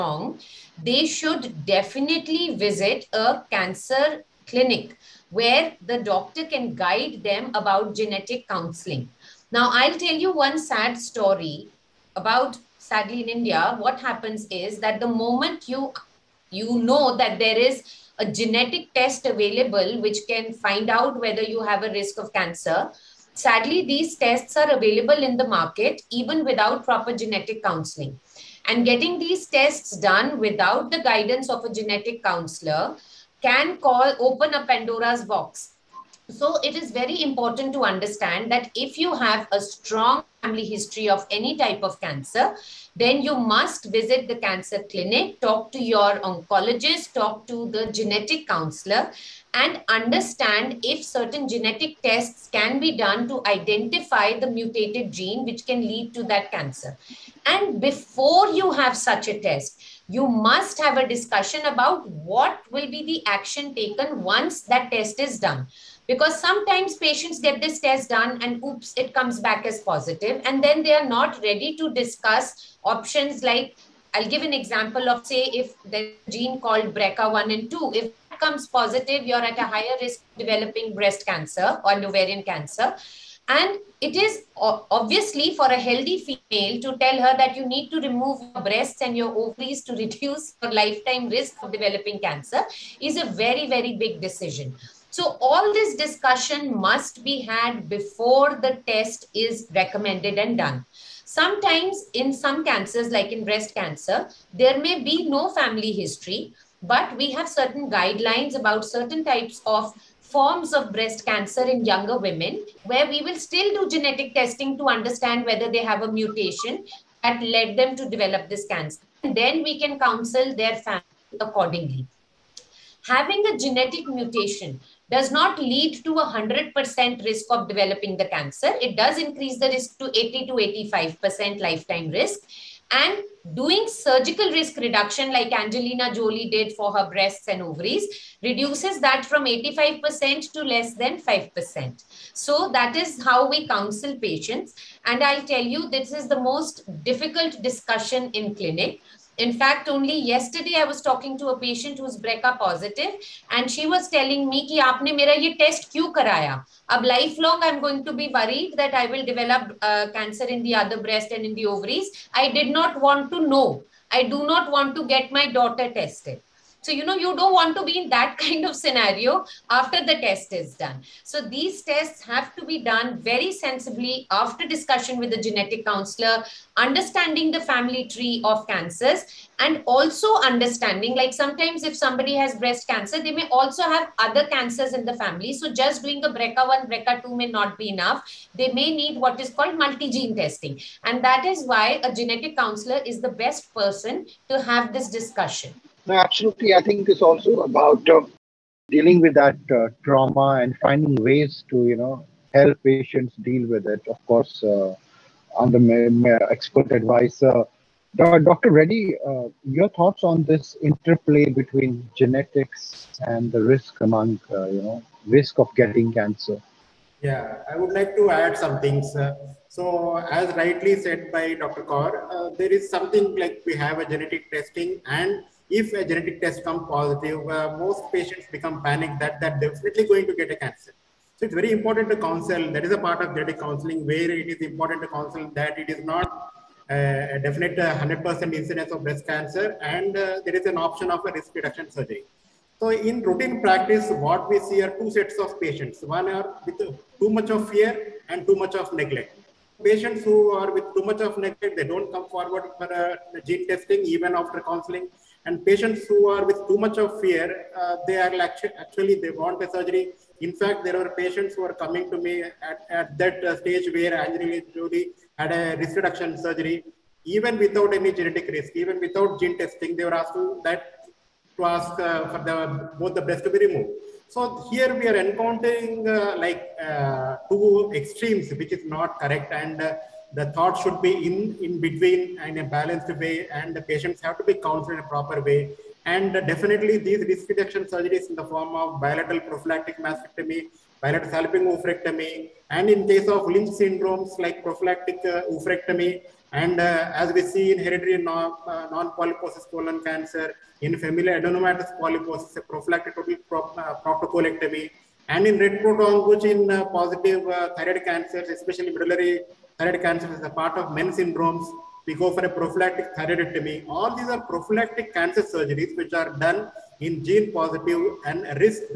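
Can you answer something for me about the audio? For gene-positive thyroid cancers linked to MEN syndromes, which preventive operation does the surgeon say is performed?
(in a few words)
prophylactic thyroidectomy.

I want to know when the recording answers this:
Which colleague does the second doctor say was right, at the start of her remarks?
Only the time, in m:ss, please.
3:41.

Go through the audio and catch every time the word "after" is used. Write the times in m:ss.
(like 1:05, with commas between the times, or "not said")
2:49, 2:54, 4:14.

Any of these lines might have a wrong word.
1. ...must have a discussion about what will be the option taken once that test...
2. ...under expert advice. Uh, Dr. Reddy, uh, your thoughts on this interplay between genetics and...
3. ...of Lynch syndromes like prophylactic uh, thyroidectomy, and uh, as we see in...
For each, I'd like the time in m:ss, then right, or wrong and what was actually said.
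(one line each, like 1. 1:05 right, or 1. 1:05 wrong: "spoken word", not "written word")
1. 1:00 wrong: "action", not "option"
2. 3:25 right
3. 4:53 wrong: "oophorectomy", not "thyroidectomy".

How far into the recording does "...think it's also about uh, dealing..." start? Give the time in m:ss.
3:16.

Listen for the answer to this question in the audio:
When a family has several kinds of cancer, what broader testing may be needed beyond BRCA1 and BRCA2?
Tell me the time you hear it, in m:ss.
3:09.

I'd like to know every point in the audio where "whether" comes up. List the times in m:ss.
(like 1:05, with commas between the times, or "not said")
0:21, 1:55.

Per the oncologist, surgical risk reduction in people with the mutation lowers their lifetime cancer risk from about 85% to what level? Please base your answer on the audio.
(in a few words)
less than 5%.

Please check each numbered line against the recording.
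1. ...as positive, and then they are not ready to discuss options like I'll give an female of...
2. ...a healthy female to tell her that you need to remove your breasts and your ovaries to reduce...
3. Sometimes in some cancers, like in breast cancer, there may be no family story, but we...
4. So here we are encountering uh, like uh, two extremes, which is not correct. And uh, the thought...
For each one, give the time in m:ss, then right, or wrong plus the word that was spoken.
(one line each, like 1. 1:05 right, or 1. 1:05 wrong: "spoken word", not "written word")
1. 1:09 wrong: "example", not "female"
2. 1:25 right
3. 1:41 wrong: "history", not "story"
4. 4:34 right.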